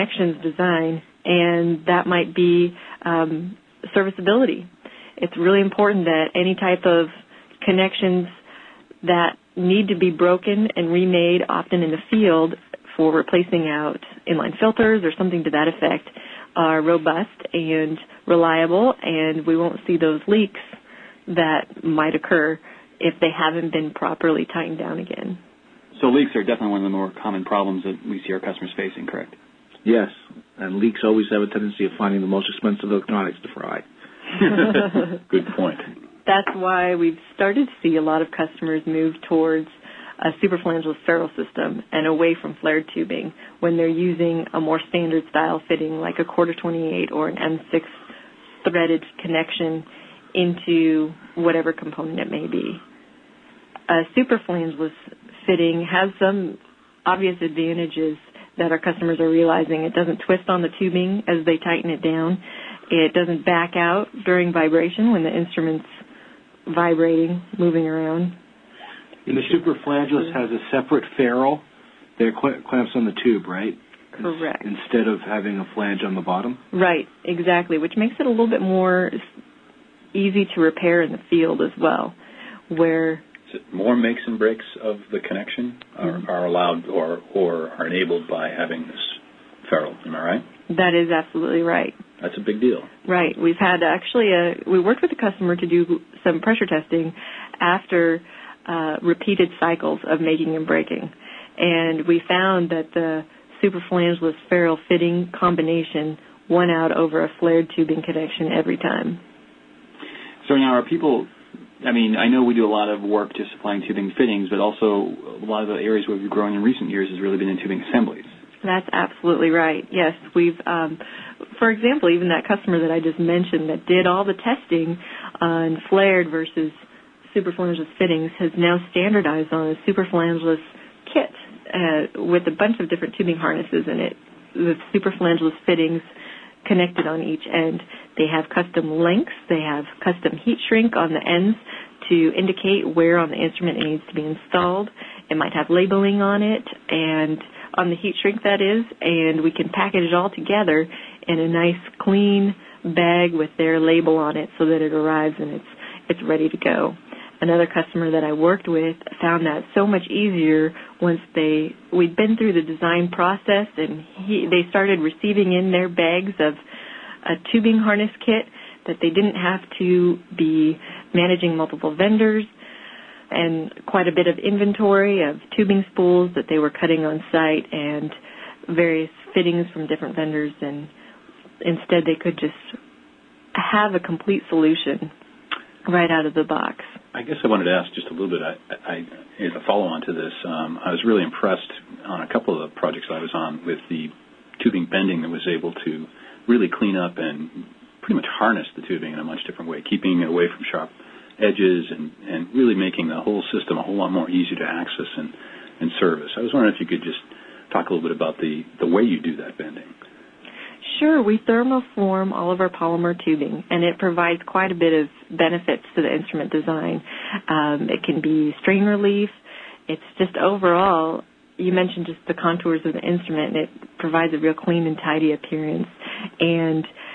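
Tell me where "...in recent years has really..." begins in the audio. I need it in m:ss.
1:56.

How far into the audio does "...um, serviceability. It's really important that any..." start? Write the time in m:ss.
0:03.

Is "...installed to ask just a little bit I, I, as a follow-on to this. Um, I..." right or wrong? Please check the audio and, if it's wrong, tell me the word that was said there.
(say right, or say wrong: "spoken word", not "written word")
wrong: "wanted", not "installed".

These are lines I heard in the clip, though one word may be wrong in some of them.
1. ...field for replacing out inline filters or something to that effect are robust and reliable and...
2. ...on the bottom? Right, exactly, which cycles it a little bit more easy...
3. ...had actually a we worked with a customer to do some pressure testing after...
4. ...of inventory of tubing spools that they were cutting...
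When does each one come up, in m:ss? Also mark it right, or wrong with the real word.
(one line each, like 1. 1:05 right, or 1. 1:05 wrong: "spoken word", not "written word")
1. 0:12 right
2. 1:16 wrong: "makes", not "cycles"
3. 1:33 right
4. 2:54 right.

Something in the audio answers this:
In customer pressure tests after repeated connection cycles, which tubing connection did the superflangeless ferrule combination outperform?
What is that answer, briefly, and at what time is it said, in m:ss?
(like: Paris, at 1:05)
flared tubing connection, at 1:47.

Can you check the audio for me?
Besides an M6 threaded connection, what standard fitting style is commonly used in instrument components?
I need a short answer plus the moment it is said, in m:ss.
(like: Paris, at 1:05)
quarter 28, at 0:46.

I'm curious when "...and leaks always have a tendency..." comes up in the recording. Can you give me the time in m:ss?
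0:30.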